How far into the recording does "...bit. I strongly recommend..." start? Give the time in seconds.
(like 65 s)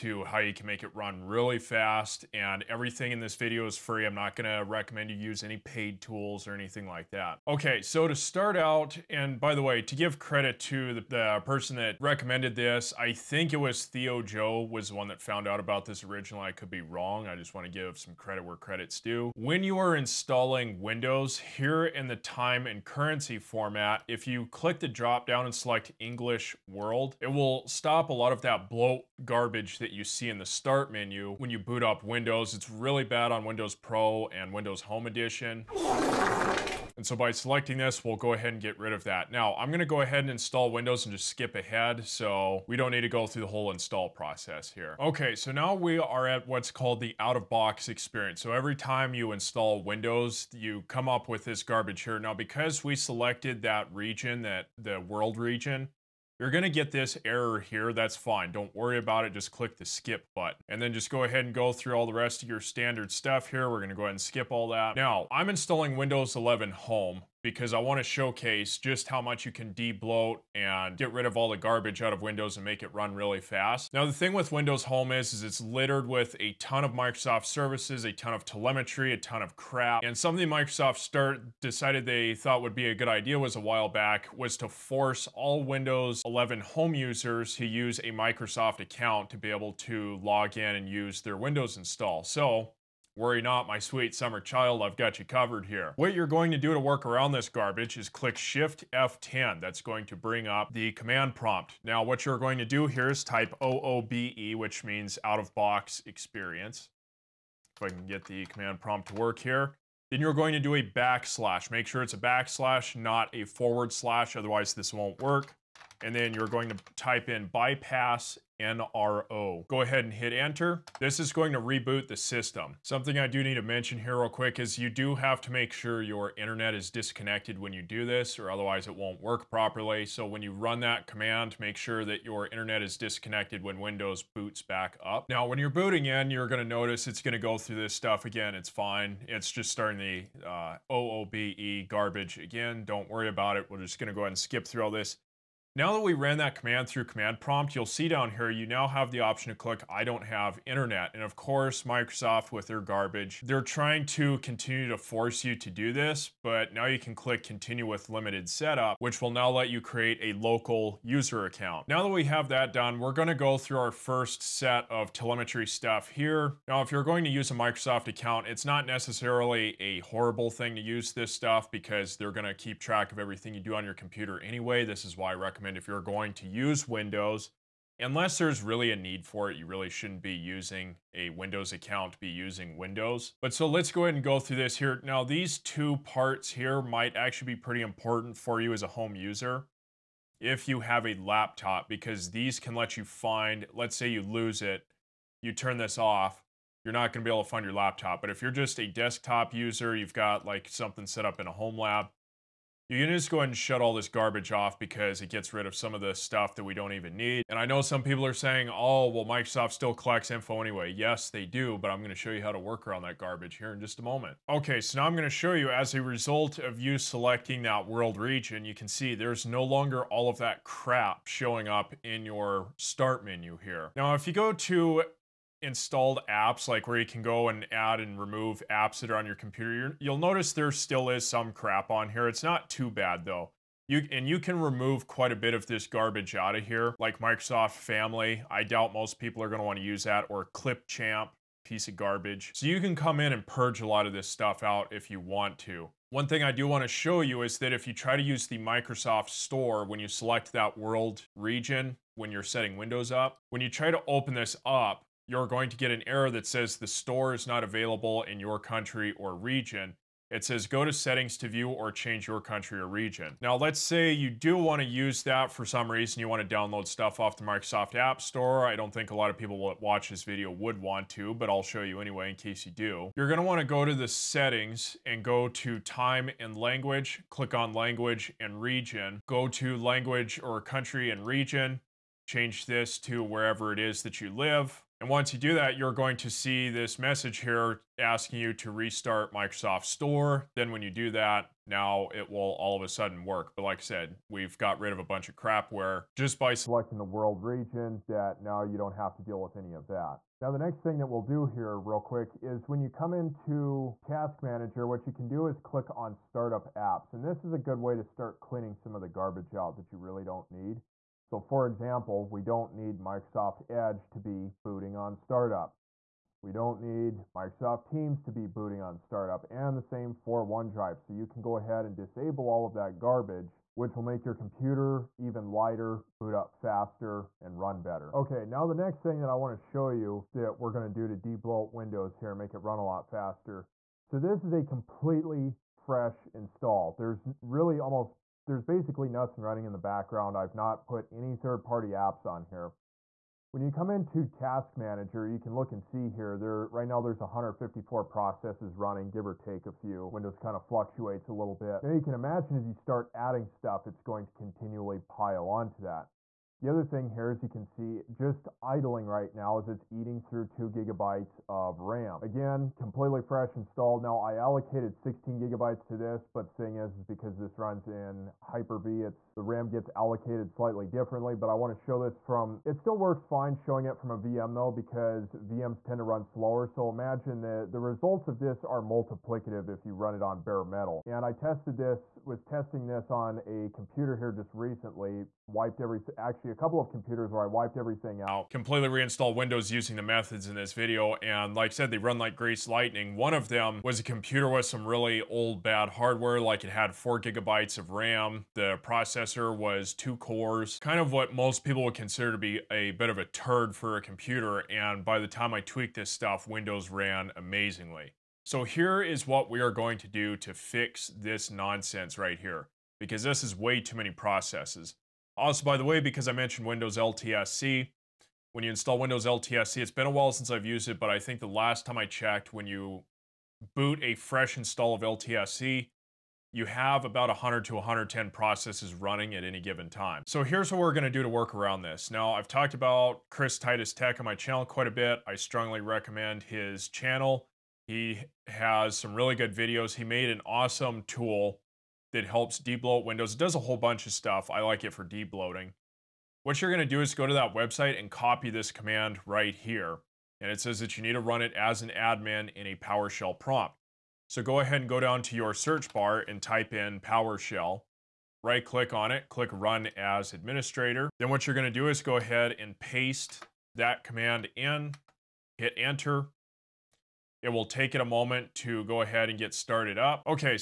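434 s.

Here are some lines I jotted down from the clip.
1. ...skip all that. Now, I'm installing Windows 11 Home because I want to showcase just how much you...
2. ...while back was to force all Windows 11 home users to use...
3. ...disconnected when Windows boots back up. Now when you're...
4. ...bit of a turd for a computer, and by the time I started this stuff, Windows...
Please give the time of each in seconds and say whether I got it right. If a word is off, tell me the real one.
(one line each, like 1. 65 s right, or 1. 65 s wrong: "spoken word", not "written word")
1. 64 s right
2. 83 s right
3. 132 s right
4. 402 s wrong: "tweaked", not "started".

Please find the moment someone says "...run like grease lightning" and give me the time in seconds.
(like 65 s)
391 s.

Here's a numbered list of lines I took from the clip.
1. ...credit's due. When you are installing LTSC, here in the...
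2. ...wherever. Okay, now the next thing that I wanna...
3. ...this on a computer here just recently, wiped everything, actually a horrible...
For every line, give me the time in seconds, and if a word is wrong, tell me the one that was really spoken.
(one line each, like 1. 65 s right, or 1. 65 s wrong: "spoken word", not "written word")
1. 18 s wrong: "Windows", not "LTSC"
2. 327 s wrong: "better", not "wherever"
3. 382 s wrong: "couple", not "horrible".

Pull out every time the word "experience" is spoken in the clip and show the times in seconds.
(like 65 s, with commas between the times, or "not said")
47 s, 106 s.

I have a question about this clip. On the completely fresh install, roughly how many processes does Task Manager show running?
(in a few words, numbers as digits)
154.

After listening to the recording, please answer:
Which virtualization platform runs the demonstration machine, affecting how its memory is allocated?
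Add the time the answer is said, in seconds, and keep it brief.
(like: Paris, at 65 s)
Hyper-V, at 368 s.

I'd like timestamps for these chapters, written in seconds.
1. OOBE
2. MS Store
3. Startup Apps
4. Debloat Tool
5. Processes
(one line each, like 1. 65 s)
1. 44 s
2. 223 s
3. 299 s
4. 429 s
5. 327 s.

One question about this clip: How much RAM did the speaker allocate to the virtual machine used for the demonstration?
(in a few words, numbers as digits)
16 gigabytes.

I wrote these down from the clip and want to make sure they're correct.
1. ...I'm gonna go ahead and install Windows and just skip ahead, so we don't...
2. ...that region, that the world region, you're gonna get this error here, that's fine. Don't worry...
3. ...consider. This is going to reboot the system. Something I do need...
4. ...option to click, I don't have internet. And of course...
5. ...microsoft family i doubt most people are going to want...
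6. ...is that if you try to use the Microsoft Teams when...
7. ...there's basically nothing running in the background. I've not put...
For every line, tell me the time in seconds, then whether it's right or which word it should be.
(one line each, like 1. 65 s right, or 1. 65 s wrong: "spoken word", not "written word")
1. 39 s right
2. 53 s right
3. 120 s wrong: "enter", not "consider"
4. 149 s right
5. 237 s right
6. 247 s wrong: "Store", not "Teams"
7. 338 s right.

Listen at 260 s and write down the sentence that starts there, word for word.
It says go to settings to view or change your country or region.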